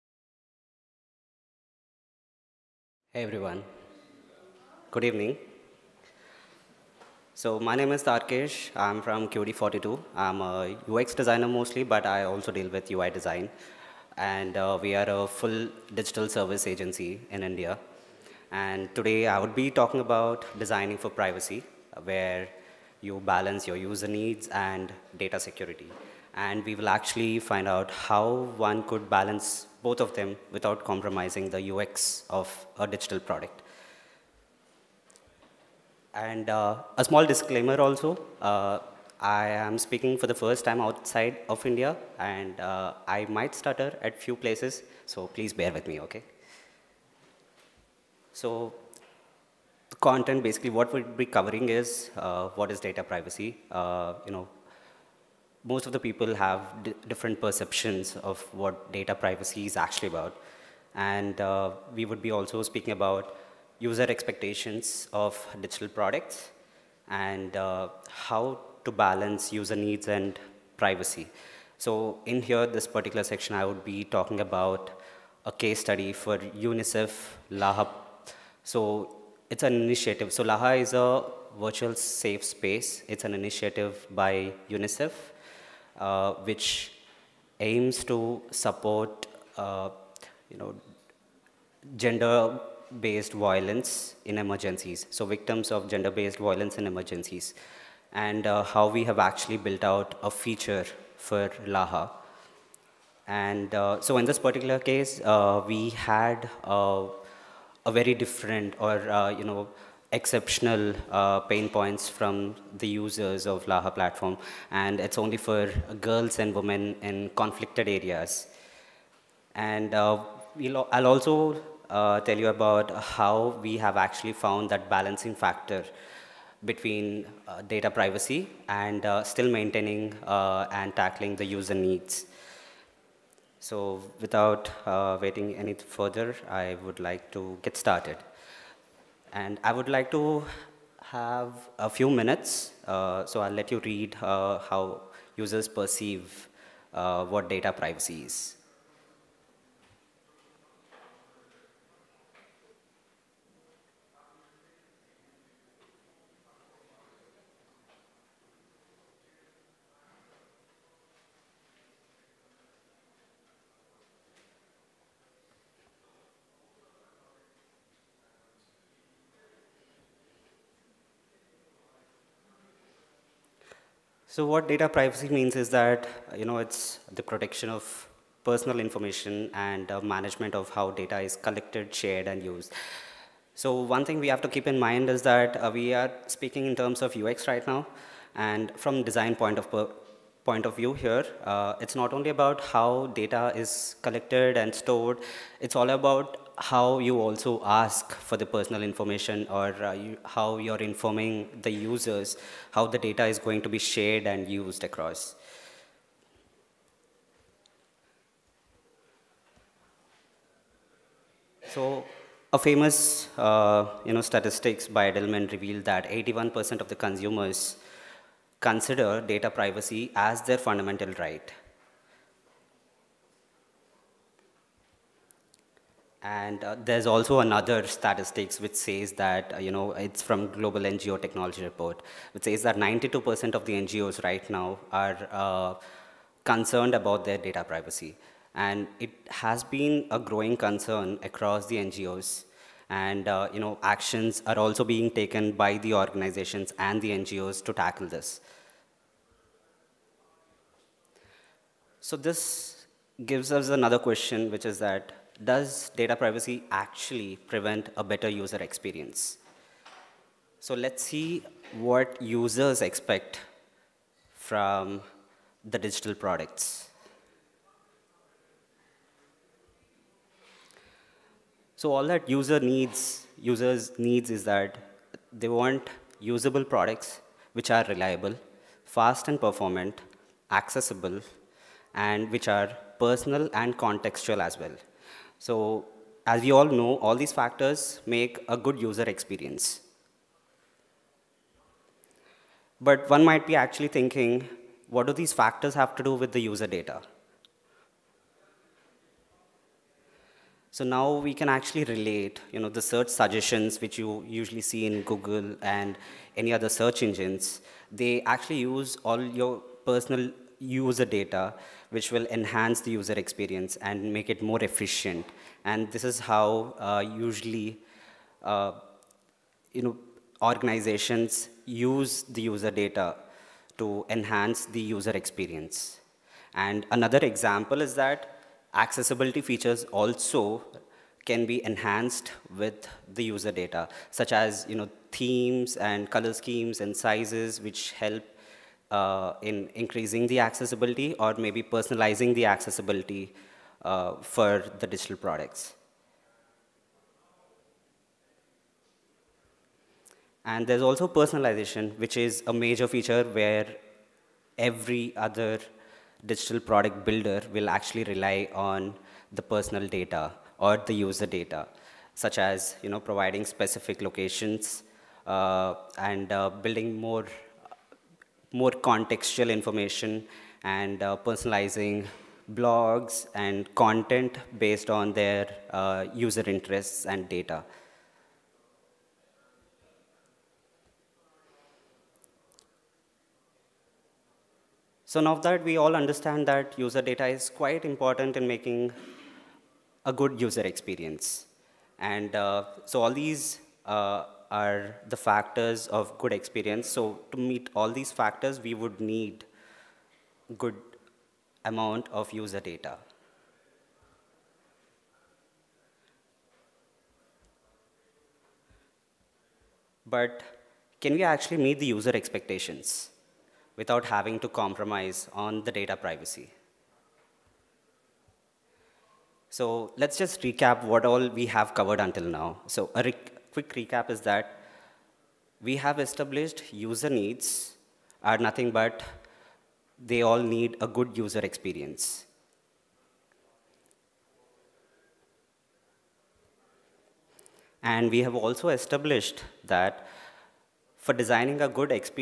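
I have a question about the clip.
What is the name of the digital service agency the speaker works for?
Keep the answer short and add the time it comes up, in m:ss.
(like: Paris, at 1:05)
QED42, at 0:09.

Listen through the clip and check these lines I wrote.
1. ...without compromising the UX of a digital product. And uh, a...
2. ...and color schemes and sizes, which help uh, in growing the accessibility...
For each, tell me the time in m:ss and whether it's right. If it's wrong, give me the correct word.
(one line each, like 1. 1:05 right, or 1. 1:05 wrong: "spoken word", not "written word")
1. 0:30 right
2. 5:35 wrong: "increasing", not "growing".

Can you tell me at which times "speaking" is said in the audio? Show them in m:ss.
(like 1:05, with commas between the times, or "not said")
0:39, 1:02, 3:06.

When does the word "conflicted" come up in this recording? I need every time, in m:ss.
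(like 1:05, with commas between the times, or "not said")
1:57.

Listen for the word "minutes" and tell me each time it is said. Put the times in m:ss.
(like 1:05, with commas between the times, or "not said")
2:22.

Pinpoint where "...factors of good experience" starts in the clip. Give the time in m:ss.
6:35.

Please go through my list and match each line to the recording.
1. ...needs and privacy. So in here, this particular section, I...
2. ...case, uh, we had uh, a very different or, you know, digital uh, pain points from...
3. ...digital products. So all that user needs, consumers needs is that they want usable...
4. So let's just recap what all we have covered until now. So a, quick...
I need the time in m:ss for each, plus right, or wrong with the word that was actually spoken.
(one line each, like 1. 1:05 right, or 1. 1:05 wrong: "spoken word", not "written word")
1. 1:09 right
2. 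1:44 wrong: "exceptional", not "digital"
3. 4:25 wrong: "users", not "consumers"
4. 6:59 right.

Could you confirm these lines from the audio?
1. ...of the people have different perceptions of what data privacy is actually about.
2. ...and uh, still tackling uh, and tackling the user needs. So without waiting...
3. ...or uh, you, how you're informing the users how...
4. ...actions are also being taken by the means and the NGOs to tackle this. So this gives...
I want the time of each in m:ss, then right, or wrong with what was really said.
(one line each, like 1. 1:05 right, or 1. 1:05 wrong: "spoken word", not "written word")
1. 0:55 right
2. 2:08 wrong: "maintaining", not "tackling"
3. 3:19 right
4. 4:03 wrong: "organizations", not "means".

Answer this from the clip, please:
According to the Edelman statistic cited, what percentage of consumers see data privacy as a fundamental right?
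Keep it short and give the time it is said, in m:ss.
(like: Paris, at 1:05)
81%, at 3:36.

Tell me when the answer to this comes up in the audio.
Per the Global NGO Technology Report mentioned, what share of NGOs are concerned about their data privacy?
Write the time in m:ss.
3:52.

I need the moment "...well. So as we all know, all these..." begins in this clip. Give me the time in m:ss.
4:44.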